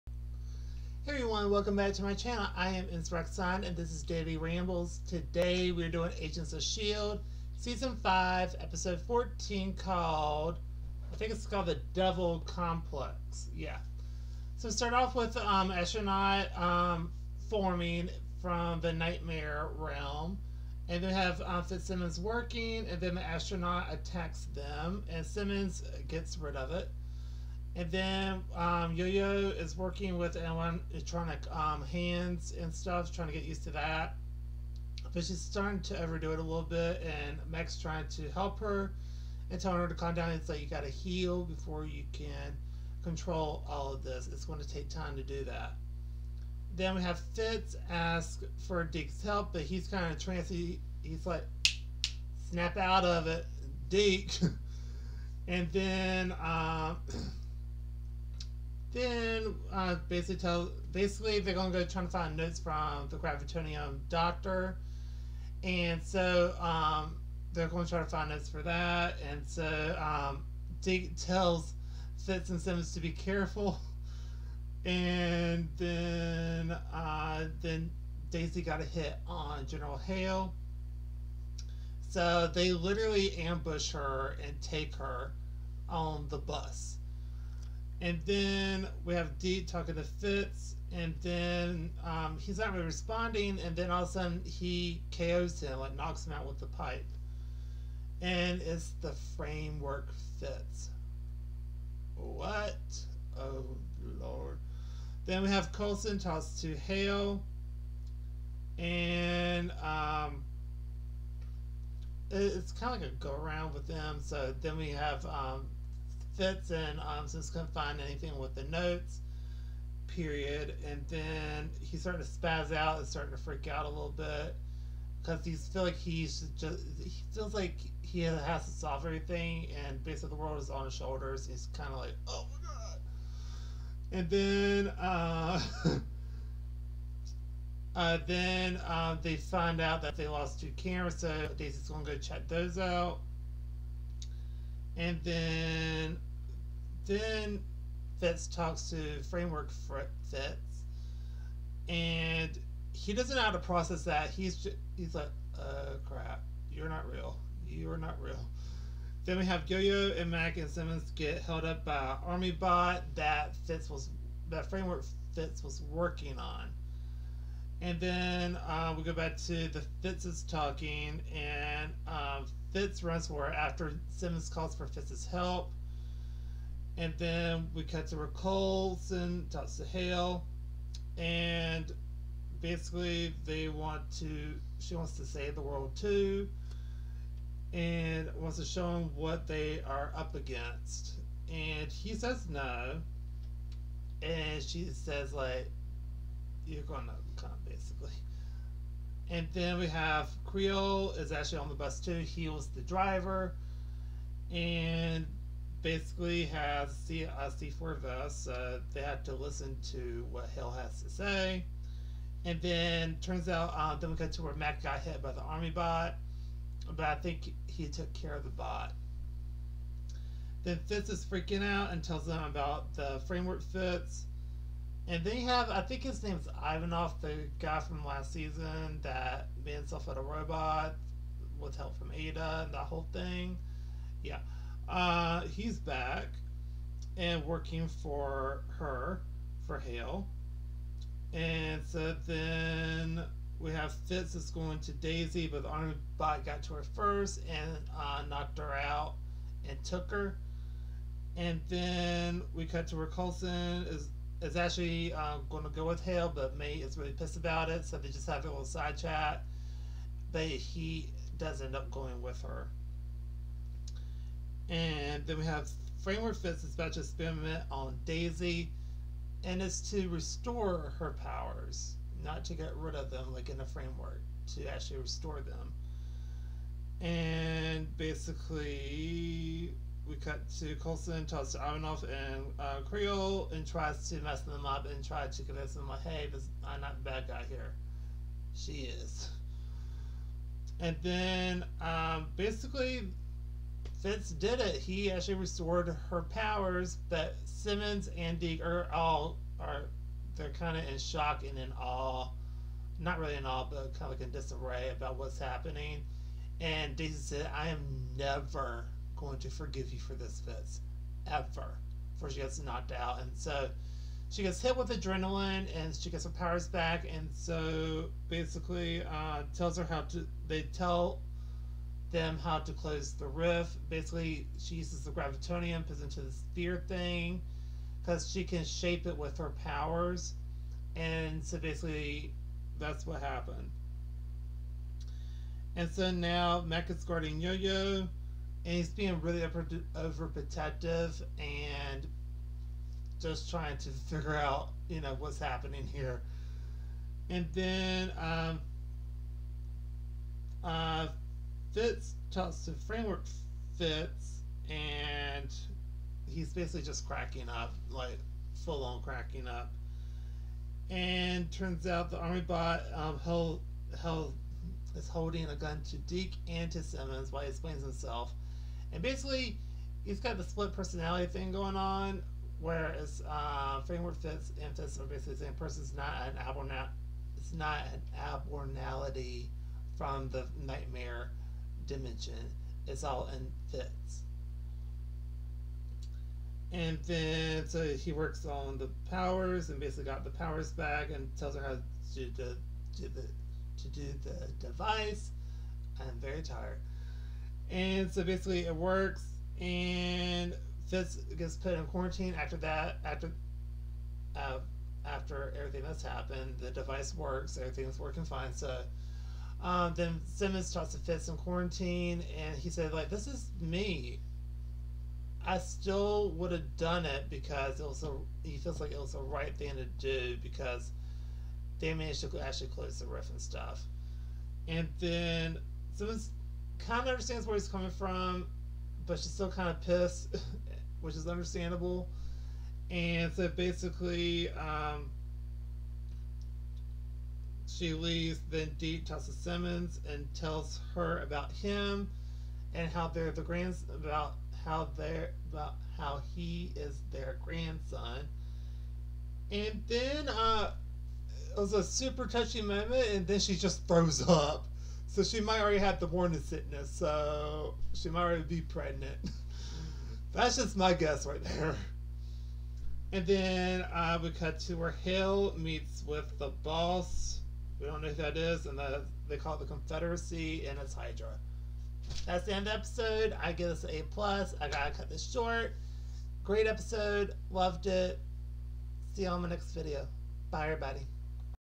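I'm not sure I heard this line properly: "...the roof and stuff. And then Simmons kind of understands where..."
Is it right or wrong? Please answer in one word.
right.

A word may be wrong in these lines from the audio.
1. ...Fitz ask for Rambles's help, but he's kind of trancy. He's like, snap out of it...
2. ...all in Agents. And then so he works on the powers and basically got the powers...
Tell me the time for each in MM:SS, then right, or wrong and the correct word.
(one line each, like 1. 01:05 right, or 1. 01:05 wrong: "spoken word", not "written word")
1. 00:47 wrong: "Deke", not "Rambles"
2. 06:23 wrong: "Fitz", not "Agents".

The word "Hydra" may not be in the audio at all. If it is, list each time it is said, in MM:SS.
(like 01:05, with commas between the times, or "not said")
07:50.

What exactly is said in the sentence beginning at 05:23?
Basically, she uses the gravitonium, puts into the sphere thing, because she can shape it with her powers.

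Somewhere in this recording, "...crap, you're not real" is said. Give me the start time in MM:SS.
02:36.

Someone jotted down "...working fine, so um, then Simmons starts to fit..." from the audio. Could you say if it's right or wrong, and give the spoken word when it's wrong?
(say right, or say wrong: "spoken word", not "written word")
right.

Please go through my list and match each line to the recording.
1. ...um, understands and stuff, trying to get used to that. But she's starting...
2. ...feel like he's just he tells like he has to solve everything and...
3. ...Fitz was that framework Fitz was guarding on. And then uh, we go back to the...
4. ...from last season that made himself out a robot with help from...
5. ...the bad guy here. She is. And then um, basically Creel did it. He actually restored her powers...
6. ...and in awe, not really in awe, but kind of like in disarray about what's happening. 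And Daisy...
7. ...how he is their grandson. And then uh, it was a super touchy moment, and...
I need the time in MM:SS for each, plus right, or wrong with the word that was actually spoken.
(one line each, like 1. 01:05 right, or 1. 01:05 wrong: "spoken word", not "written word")
1. 00:31 wrong: "hands", not "understands"
2. 02:05 wrong: "feels", not "tells"
3. 02:43 wrong: "working", not "guarding"
4. 03:47 right
5. 04:47 wrong: "Fitz", not "Creel"
6. 05:01 right
7. 07:25 right.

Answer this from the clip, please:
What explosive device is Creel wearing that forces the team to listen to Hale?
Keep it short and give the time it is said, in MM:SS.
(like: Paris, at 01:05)
C4 vest, at 03:27.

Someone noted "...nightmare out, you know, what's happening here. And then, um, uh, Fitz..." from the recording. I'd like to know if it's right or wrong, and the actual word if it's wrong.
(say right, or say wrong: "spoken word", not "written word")
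wrong: "figure", not "nightmare".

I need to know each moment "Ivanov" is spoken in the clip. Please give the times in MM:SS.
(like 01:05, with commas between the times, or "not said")
03:46, 04:41.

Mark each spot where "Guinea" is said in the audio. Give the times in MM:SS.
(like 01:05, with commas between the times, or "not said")
not said.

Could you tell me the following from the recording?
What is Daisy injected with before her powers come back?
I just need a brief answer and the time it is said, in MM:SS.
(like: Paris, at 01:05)
Adrenaline, at 05:14.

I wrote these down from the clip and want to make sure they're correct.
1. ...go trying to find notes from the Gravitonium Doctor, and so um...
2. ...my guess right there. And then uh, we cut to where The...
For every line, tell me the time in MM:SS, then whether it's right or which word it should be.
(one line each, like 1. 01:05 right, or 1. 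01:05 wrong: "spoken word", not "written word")
1. 01:01 right
2. 07:40 wrong: "Hale", not "The".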